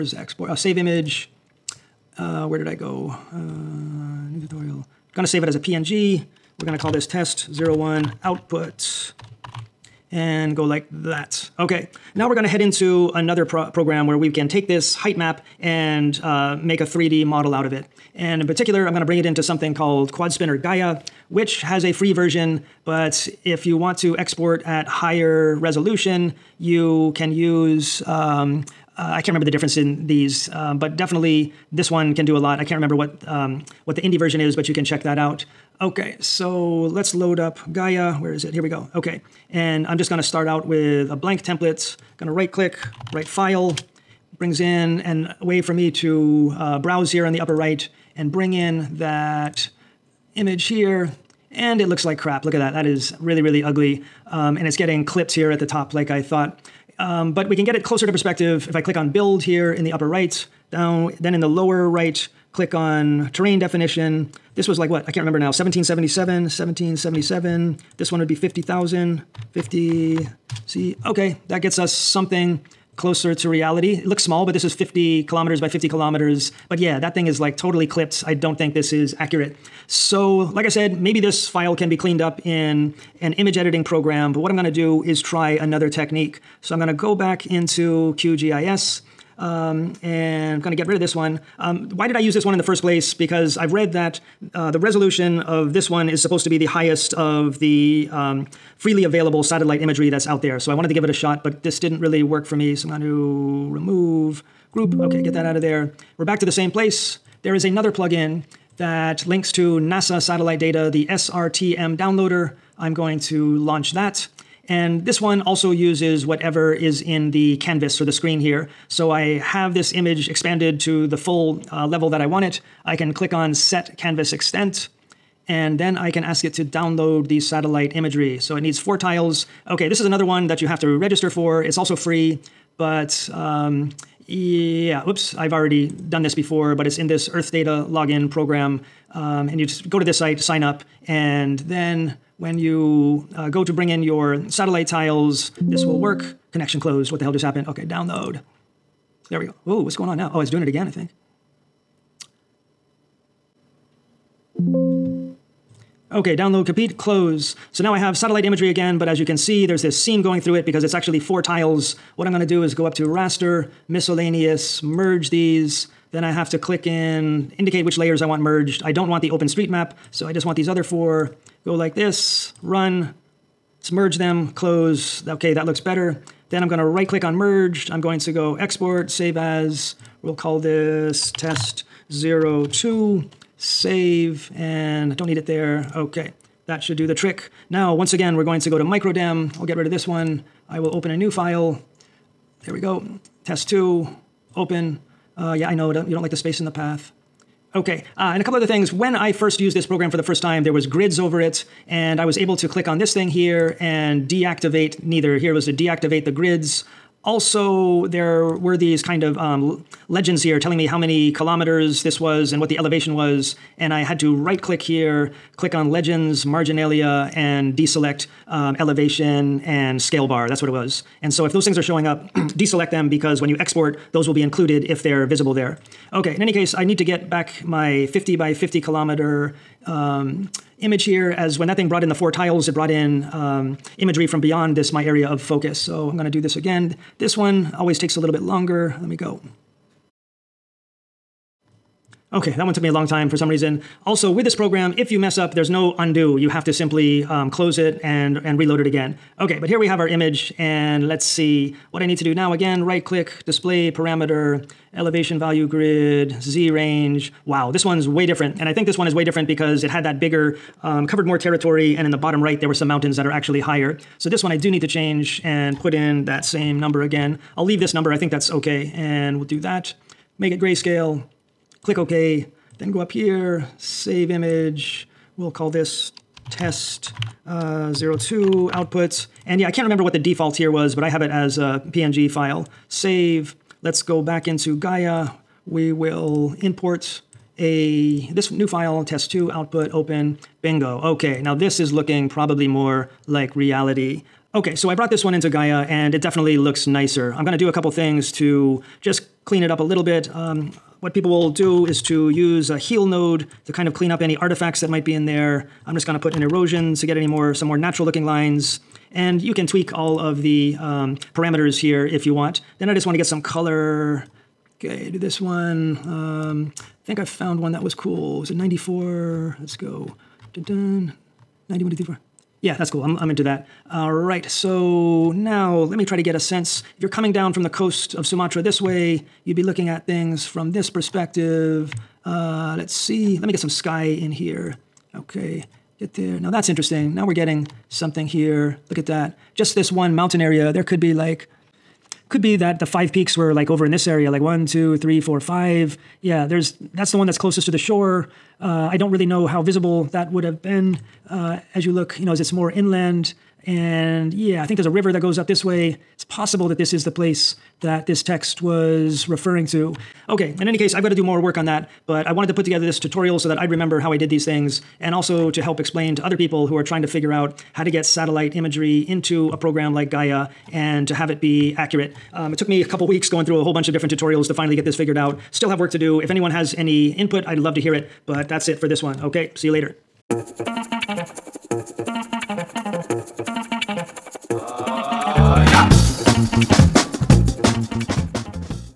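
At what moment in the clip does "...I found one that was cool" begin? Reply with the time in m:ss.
5:17.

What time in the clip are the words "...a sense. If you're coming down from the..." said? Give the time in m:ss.
5:26.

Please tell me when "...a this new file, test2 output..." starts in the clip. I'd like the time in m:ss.
4:47.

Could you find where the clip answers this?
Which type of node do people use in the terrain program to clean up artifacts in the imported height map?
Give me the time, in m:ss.
5:02.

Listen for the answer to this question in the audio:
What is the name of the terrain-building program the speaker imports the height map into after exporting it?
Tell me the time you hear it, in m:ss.
0:20.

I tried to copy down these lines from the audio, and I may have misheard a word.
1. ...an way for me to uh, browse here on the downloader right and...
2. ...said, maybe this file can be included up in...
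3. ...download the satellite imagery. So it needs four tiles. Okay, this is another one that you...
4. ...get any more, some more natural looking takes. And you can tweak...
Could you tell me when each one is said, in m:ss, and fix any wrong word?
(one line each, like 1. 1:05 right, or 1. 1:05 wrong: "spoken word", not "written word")
1. 0:45 wrong: "upper", not "downloader"
2. 1:20 wrong: "cleaned", not "included"
3. 2:06 right
4. 5:07 wrong: "lines", not "takes".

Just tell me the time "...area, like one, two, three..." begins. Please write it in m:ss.
5:44.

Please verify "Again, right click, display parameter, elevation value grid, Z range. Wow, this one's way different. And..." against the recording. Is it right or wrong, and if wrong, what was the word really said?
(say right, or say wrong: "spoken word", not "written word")
right.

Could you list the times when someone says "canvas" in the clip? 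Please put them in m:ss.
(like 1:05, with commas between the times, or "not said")
1:57, 2:03.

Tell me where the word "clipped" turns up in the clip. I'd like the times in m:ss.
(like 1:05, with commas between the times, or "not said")
0:55, 1:17.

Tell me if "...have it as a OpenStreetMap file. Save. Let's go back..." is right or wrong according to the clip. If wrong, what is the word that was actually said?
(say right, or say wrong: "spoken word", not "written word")
wrong: "PNG", not "OpenStreetMap".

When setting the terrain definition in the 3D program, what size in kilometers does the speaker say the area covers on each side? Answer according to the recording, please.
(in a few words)
50 kilometers.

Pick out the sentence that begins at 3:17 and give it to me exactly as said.
Okay, uh, and a couple other things.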